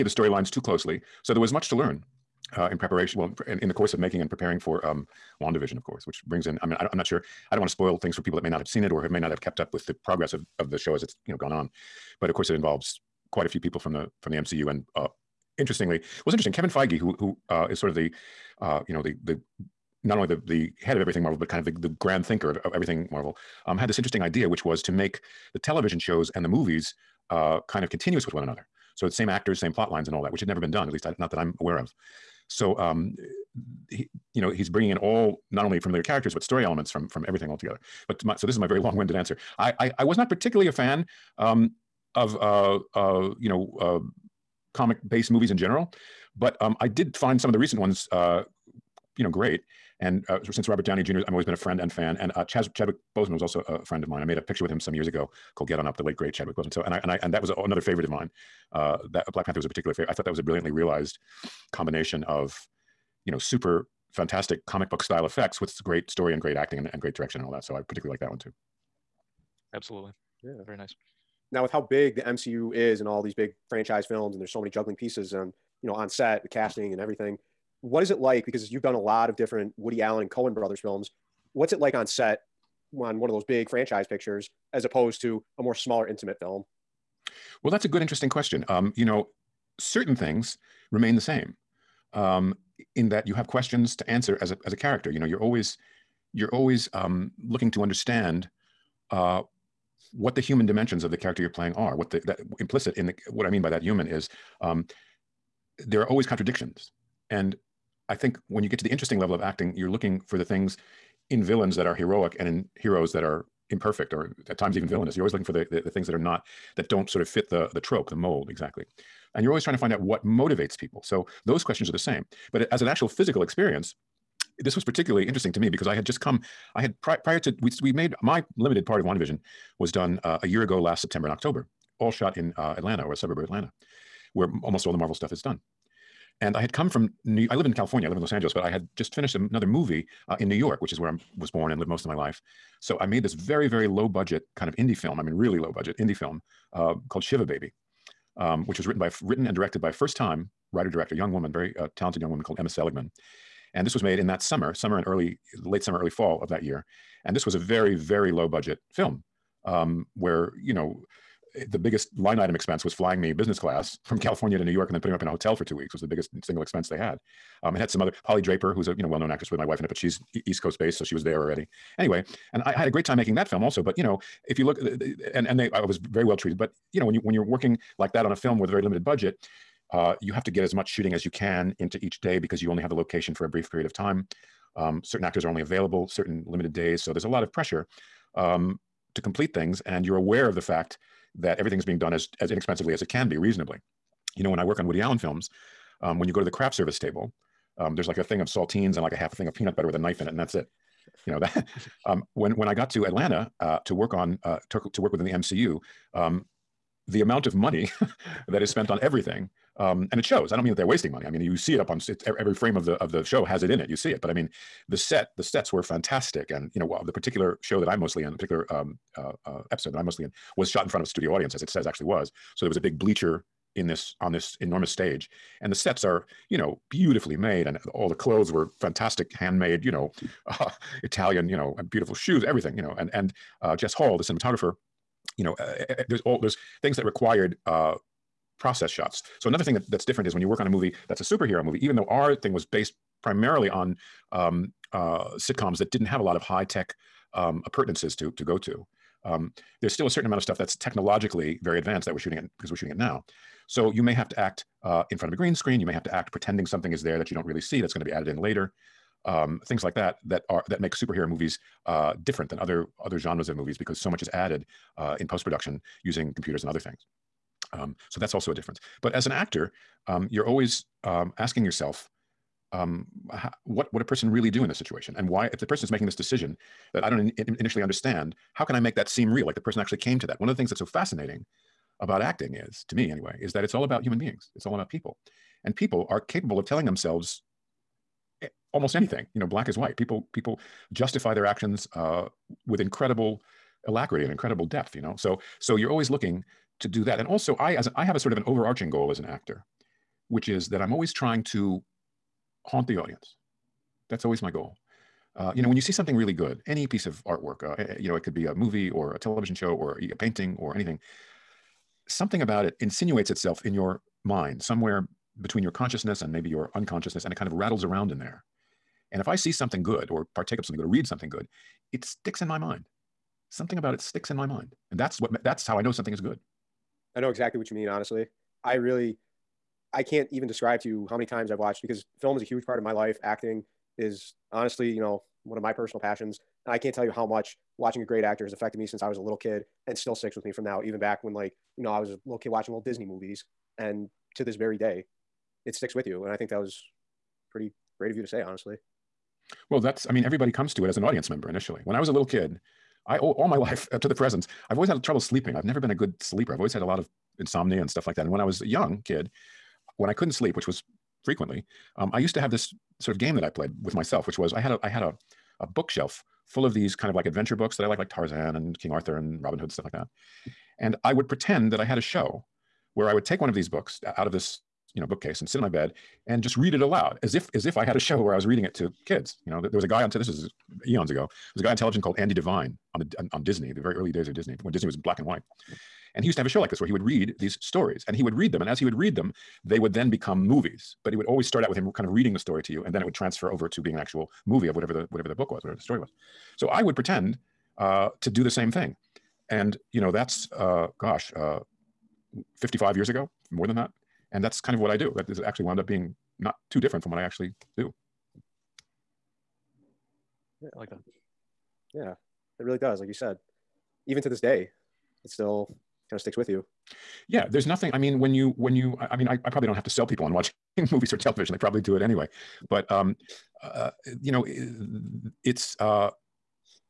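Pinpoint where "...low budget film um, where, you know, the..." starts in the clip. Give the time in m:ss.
2:38.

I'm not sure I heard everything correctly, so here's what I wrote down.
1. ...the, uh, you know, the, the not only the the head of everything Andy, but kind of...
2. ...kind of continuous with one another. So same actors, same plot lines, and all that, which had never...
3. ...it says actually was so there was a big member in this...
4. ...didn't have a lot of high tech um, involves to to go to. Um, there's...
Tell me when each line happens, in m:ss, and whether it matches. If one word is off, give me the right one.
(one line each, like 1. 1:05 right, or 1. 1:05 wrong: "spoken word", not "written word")
1. 0:17 wrong: "Marvel", not "Andy"
2. 0:27 right
3. 3:41 wrong: "bleacher", not "member"
4. 4:05 wrong: "appurtenances", not "involves".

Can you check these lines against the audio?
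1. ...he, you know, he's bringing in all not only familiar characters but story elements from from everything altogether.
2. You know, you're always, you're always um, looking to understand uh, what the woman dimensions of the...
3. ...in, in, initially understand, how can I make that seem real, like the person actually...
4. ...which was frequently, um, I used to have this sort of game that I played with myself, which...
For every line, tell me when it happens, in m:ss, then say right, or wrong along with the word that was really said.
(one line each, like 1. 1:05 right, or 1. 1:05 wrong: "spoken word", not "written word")
1. 0:33 right
2. 1:35 wrong: "human", not "woman"
3. 4:37 right
4. 6:00 right.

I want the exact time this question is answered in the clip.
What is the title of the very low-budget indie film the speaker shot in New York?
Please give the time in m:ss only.
2:27.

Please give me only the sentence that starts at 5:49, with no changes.
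Well, that's, I mean, everybody comes to it as an audience member initially.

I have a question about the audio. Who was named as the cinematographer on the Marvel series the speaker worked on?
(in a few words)
Jess Hall.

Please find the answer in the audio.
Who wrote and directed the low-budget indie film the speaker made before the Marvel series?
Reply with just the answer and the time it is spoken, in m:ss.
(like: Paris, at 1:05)
Emma Seligman, at 2:32.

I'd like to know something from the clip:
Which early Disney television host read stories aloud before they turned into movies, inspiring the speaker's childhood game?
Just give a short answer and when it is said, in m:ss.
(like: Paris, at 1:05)
Andy Devine, at 6:22.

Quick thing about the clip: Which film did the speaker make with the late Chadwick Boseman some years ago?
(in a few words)
Get On Up.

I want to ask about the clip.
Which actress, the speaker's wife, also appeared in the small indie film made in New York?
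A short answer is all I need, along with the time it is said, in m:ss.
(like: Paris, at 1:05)
Polly Draper, at 2:48.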